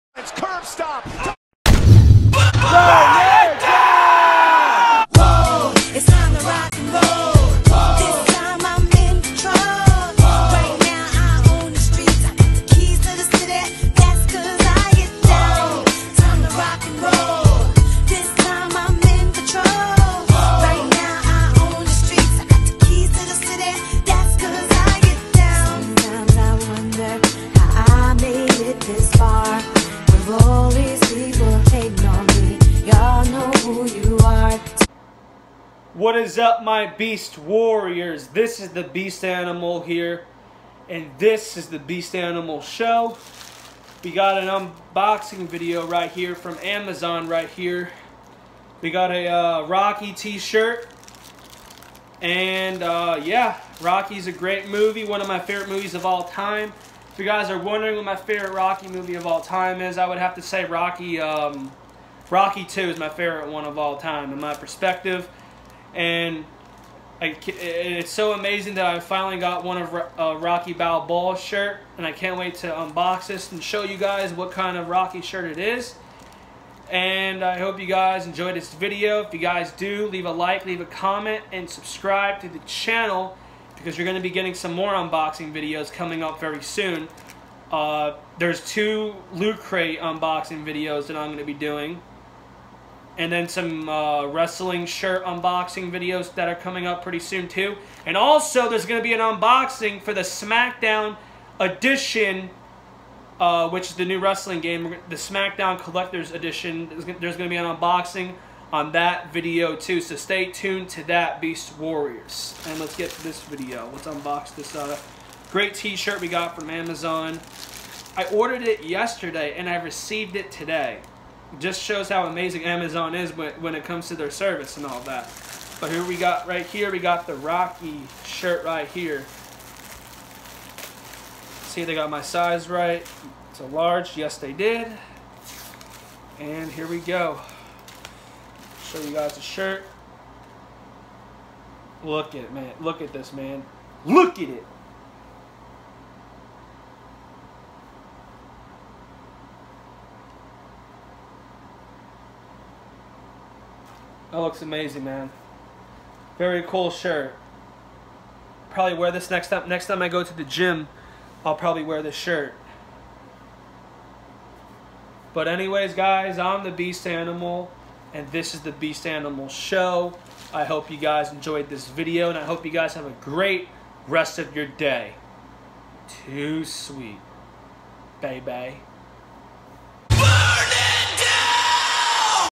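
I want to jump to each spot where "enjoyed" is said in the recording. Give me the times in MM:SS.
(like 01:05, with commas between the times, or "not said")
01:18, 02:51.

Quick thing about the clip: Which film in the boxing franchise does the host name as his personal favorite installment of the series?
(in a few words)
Rocky 2.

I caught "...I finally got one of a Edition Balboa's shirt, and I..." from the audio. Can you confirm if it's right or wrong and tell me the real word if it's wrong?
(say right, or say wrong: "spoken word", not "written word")
wrong: "Rocky", not "Edition".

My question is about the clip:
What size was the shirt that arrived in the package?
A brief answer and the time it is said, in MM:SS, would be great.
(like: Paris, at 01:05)
Large, at 02:13.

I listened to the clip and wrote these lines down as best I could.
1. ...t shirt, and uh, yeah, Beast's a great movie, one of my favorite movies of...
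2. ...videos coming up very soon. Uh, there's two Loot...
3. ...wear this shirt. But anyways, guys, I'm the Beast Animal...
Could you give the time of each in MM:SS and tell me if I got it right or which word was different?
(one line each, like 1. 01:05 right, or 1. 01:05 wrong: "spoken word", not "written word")
1. 00:50 wrong: "Rocky", not "Beast"
2. 01:25 right
3. 02:41 right.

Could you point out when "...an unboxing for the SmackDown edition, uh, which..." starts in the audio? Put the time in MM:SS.
01:39.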